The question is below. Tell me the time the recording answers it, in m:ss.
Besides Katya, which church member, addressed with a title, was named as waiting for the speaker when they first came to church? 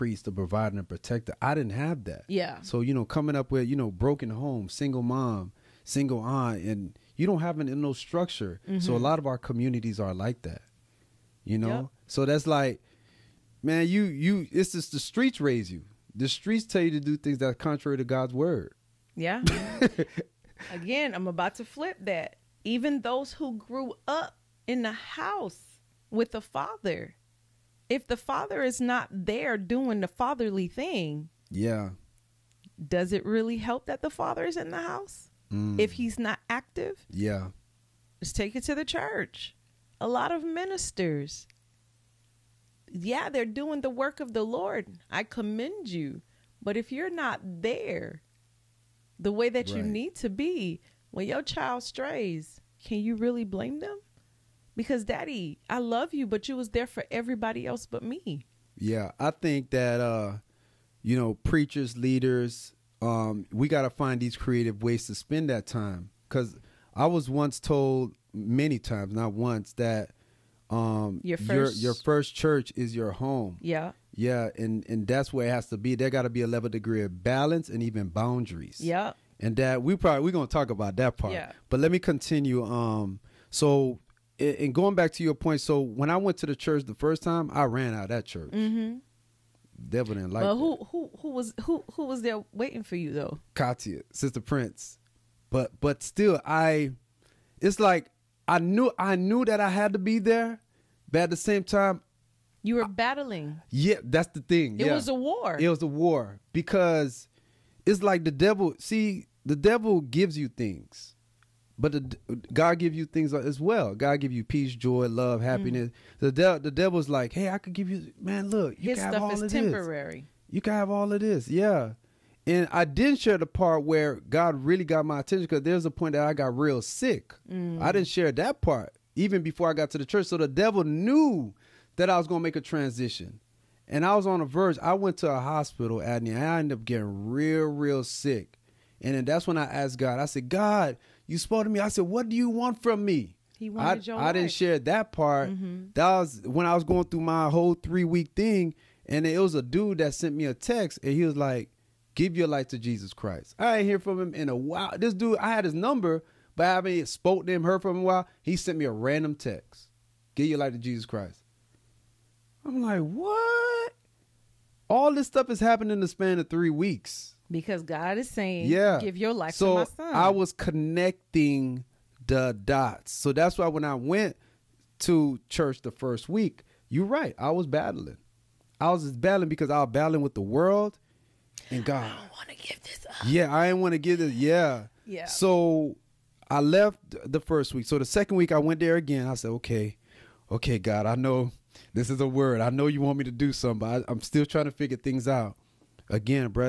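1:34.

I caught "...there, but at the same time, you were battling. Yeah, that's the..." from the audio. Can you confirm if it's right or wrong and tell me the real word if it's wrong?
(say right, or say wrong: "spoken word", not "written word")
right.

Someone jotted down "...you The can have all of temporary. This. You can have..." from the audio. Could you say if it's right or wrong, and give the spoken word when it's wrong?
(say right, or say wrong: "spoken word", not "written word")
wrong: "His", not "The".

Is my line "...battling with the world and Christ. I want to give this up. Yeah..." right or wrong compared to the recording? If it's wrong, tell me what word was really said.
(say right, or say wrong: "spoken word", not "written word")
wrong: "God", not "Christ".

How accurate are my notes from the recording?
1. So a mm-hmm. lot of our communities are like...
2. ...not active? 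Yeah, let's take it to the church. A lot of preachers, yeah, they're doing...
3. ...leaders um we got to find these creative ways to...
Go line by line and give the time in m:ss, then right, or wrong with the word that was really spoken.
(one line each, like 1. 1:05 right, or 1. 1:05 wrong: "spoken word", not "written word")
1. 0:08 right
2. 0:36 wrong: "ministers", not "preachers"
3. 1:01 right.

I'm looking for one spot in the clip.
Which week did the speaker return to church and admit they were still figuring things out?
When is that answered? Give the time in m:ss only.
3:08.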